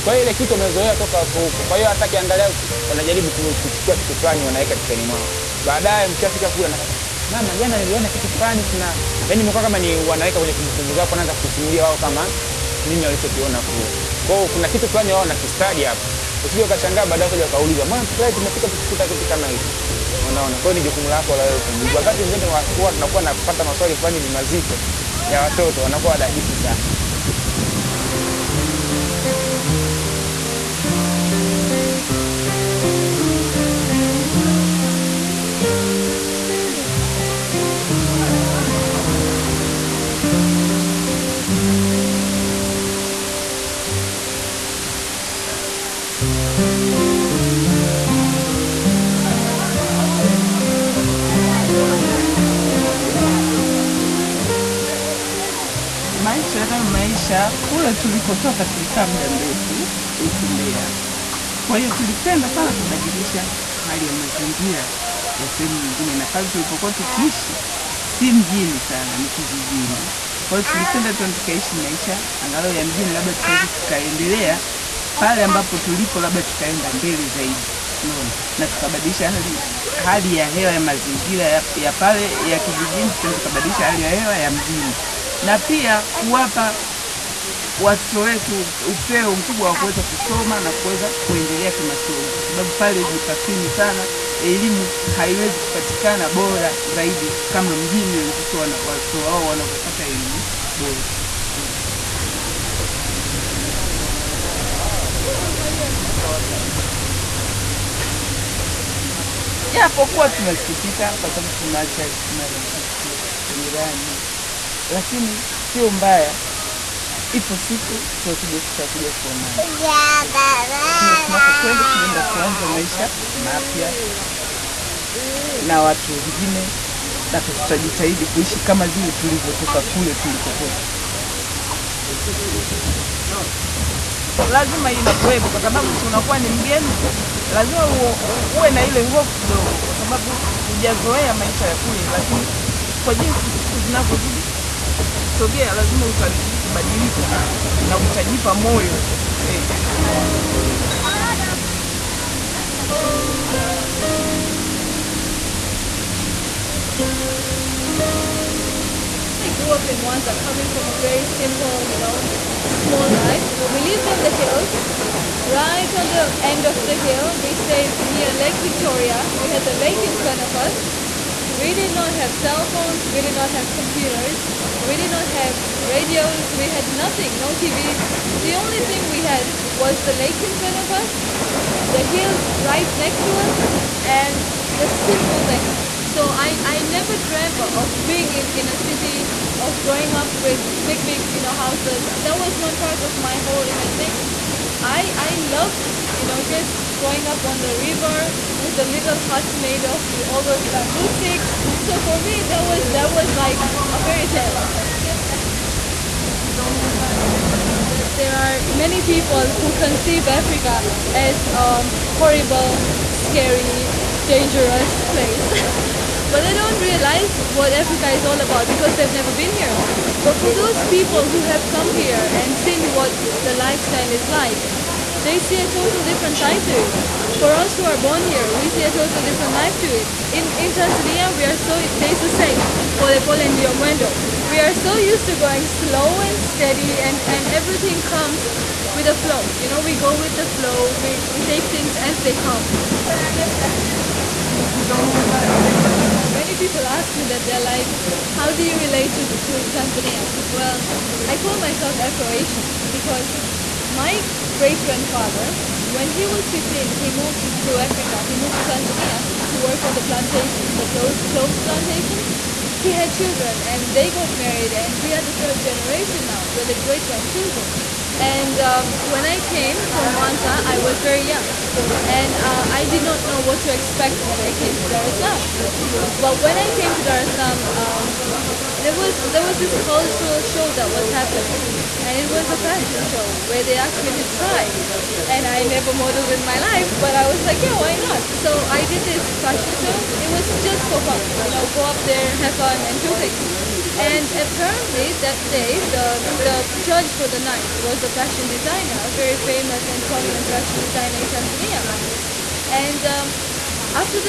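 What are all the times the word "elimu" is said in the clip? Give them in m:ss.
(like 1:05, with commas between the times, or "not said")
1:34, 1:40.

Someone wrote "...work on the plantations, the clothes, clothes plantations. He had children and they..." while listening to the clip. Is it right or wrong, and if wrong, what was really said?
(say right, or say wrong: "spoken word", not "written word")
right.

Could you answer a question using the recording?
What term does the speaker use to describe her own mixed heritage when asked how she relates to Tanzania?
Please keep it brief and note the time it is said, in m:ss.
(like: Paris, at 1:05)
Afro-Asian, at 4:11.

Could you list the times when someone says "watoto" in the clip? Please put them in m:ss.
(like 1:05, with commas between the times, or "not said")
0:25, 1:27, 1:38.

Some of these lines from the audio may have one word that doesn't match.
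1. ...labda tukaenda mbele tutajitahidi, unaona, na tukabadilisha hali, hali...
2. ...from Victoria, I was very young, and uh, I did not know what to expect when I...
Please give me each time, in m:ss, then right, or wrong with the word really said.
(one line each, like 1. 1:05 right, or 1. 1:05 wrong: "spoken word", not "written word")
1. 1:16 wrong: "zaidi", not "tutajitahidi"
2. 4:29 wrong: "Mwanza", not "Victoria".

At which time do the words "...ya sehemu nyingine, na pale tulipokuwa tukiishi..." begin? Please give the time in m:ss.
1:05.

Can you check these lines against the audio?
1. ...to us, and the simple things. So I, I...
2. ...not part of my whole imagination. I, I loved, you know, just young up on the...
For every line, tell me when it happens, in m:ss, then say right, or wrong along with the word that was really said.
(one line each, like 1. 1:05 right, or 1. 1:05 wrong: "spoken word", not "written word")
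1. 3:03 right
2. 3:12 wrong: "growing", not "young".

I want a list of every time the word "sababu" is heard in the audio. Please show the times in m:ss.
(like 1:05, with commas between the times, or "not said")
1:32, 1:51, 2:15, 2:19.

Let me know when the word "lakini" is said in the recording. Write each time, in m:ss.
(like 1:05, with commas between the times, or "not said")
1:54, 2:22.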